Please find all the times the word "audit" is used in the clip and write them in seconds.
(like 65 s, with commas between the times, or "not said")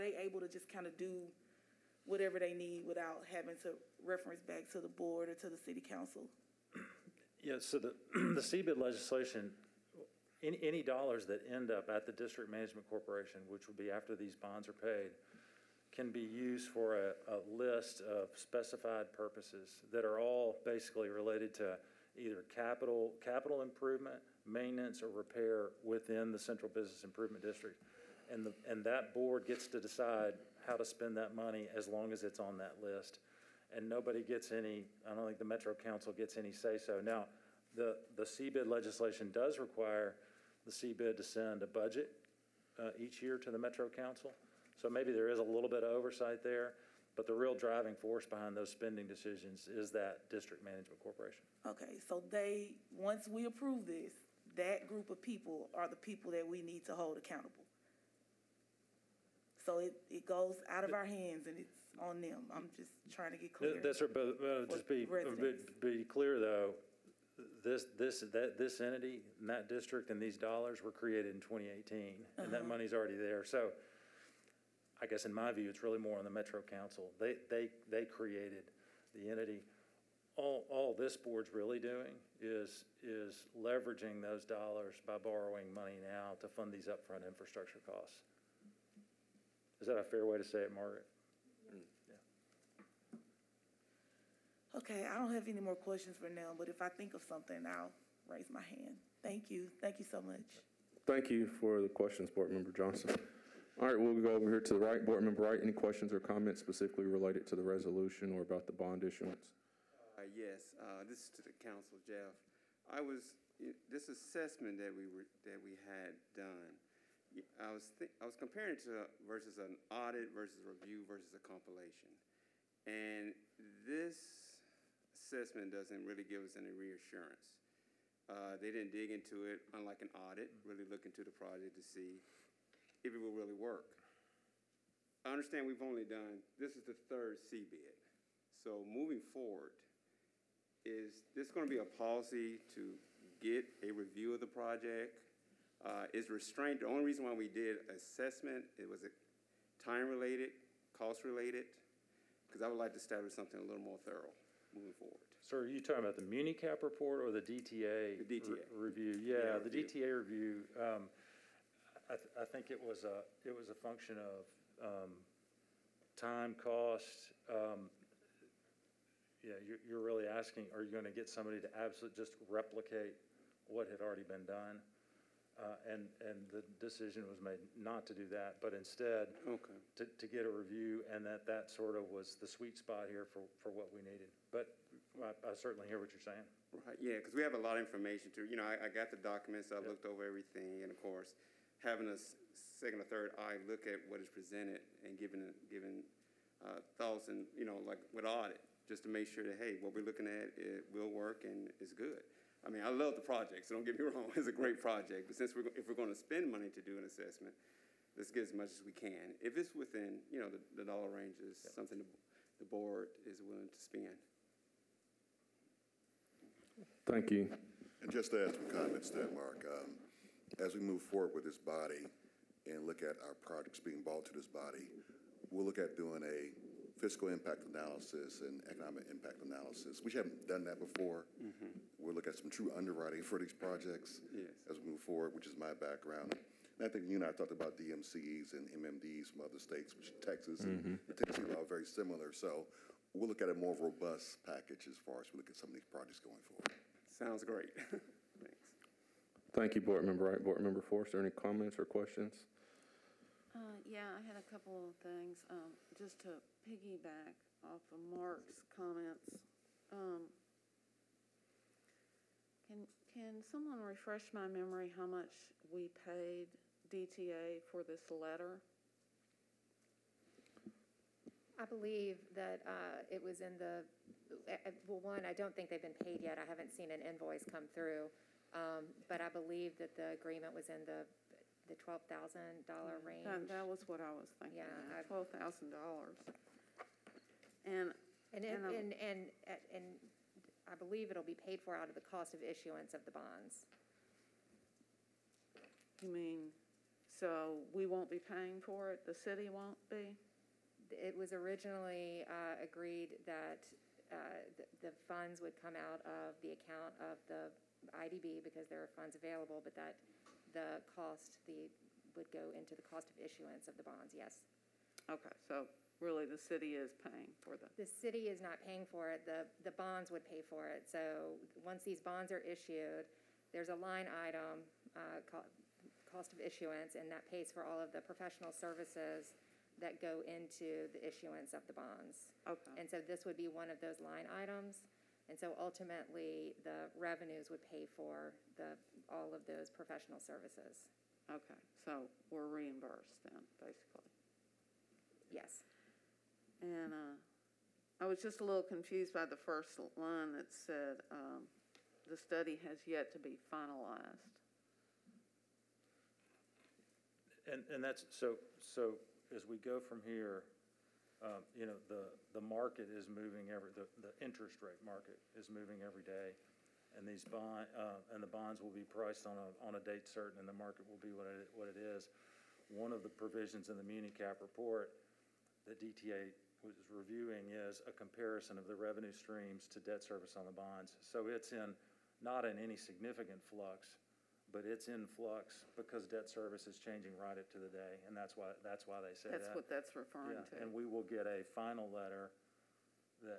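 119 s, 130 s, 198 s.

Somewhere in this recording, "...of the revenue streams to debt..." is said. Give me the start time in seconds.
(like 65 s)
378 s.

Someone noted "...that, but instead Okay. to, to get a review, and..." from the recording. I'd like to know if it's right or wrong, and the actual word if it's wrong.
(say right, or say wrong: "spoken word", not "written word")
right.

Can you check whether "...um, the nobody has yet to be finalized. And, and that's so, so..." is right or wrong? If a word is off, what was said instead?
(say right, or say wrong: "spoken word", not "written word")
wrong: "study", not "nobody".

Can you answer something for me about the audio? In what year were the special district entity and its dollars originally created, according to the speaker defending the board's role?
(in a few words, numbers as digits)
2018.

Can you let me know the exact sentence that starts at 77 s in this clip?
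They they they created the entity.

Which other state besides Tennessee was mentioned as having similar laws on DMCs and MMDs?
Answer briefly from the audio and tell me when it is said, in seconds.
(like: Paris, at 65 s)
Texas, at 240 s.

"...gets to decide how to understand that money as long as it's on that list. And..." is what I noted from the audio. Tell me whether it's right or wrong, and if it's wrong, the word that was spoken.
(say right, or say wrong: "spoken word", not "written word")
wrong: "spend", not "understand".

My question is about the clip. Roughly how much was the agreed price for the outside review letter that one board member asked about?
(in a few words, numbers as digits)
$12,000.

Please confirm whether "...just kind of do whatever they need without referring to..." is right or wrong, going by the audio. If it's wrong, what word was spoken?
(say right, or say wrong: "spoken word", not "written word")
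wrong: "having", not "referring".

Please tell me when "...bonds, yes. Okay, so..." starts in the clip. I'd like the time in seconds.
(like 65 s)
313 s.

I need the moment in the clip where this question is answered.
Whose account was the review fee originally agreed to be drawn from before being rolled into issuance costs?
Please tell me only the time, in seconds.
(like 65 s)
308 s.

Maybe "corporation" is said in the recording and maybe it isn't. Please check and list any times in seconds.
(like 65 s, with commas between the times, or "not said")
12 s, 51 s.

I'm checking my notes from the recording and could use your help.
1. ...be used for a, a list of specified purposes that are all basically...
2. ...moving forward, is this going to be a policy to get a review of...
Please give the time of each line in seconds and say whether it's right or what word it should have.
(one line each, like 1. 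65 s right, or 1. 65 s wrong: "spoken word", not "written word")
1. 16 s right
2. 138 s right.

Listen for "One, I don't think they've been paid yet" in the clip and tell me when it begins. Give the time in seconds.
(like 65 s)
275 s.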